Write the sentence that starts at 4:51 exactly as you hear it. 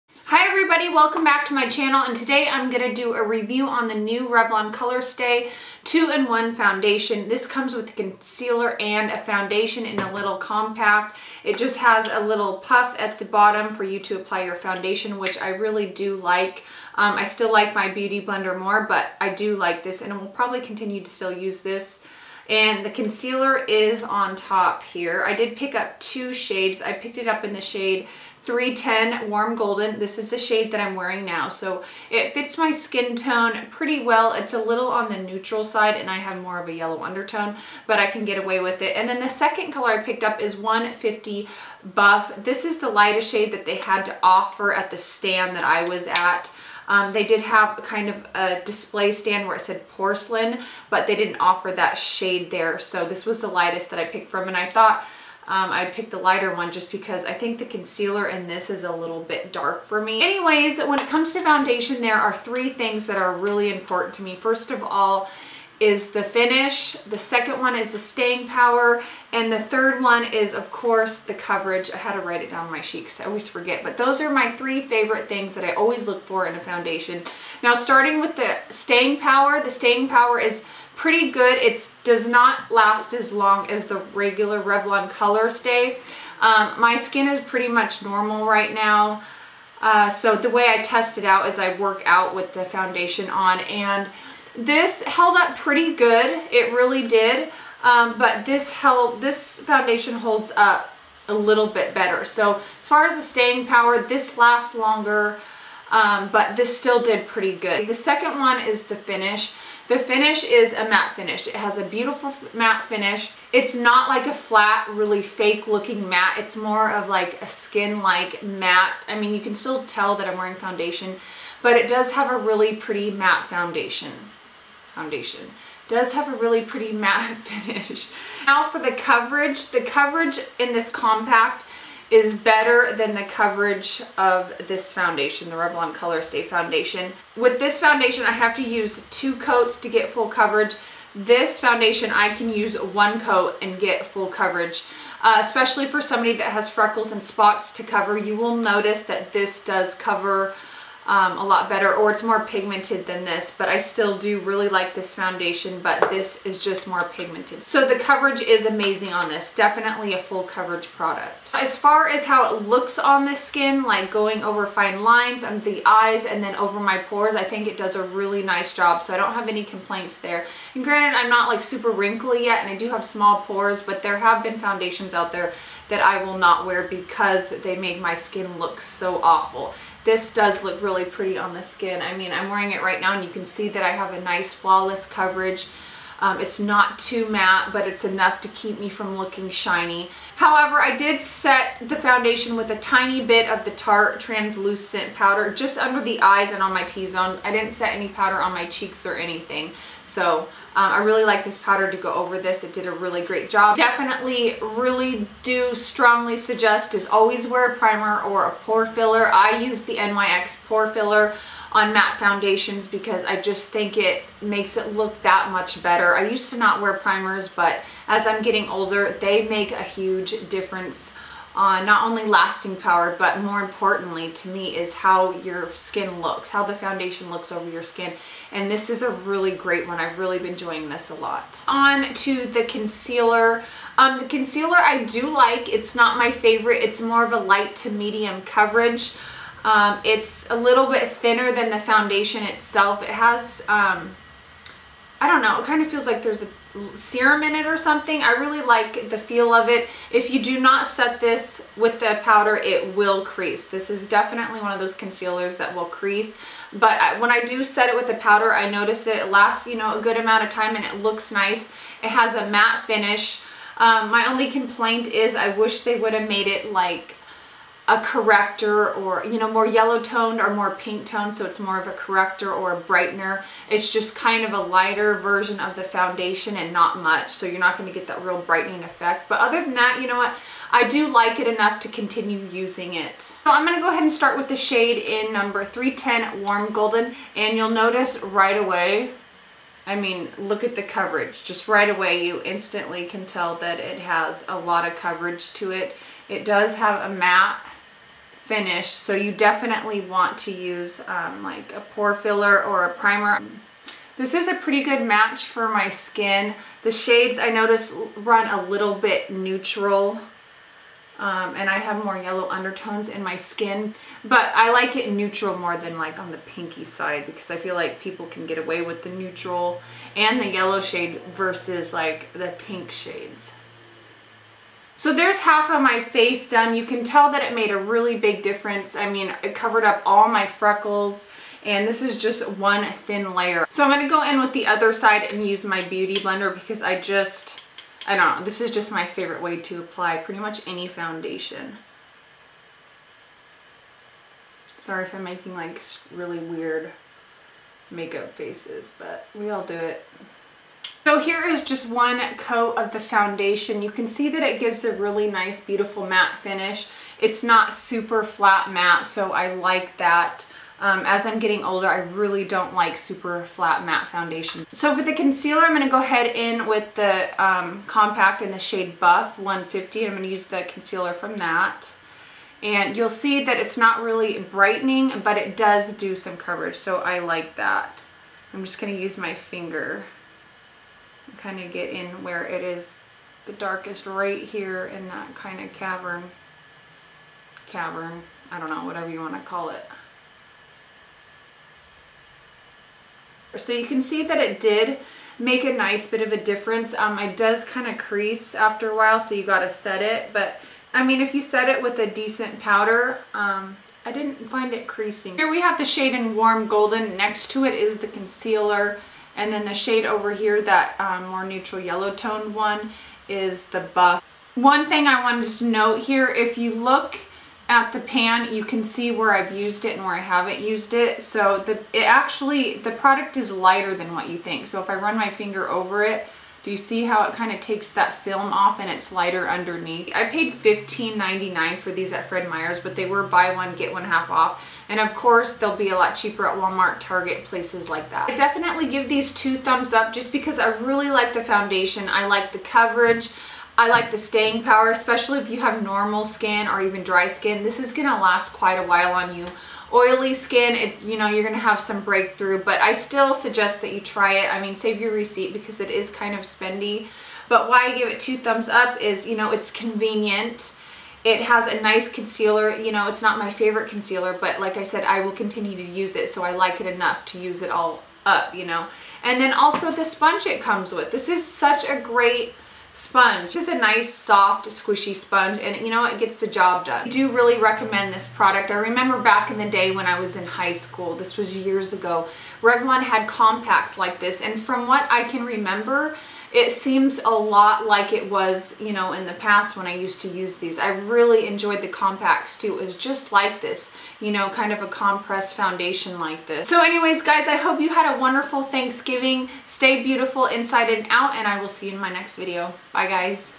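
Just right away, you instantly can tell that it has a lot of coverage to it.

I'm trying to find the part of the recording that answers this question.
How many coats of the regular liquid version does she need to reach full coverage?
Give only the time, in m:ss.
2:19.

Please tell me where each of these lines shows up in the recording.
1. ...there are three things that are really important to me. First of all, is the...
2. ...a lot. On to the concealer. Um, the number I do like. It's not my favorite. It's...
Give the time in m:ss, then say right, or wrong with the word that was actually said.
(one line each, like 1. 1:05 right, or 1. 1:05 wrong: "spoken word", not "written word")
1. 1:02 right
2. 3:51 wrong: "concealer", not "number".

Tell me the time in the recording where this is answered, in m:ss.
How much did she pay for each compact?
7:10.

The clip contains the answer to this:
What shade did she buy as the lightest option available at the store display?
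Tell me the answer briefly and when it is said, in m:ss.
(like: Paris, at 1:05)
150 Buff, at 0:40.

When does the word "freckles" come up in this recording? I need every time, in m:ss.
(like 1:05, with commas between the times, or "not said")
2:26, 5:30.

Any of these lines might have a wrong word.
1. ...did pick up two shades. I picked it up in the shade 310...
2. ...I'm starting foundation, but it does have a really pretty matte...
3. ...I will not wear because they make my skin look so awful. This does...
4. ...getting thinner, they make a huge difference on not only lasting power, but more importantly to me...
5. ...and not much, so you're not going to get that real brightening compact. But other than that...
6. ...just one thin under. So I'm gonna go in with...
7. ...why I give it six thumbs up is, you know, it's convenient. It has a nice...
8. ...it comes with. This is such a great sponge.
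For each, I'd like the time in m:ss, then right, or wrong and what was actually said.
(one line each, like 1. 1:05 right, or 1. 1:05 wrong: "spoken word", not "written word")
1. 0:25 right
2. 2:00 wrong: "wearing", not "starting"
3. 2:56 right
4. 3:38 wrong: "older", not "thinner"
5. 4:36 wrong: "effect", not "compact"
6. 5:32 wrong: "layer", not "under"
7. 7:37 wrong: "two", not "six"
8. 7:50 right.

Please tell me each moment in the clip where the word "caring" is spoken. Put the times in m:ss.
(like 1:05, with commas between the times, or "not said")
not said.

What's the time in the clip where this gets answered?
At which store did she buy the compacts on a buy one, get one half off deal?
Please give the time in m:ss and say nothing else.
7:12.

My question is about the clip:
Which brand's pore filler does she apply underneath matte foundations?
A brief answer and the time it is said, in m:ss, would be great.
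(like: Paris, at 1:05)
NYX, at 3:29.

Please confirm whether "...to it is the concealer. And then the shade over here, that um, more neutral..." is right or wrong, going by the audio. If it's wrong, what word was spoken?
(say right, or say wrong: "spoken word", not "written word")
right.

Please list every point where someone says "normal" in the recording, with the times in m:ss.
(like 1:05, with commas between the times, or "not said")
1:28, 7:25.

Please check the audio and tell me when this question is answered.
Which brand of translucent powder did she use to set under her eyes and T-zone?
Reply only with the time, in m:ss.
3:13.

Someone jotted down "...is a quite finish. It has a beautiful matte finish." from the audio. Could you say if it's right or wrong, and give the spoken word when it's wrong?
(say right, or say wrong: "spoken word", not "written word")
wrong: "matte", not "quite".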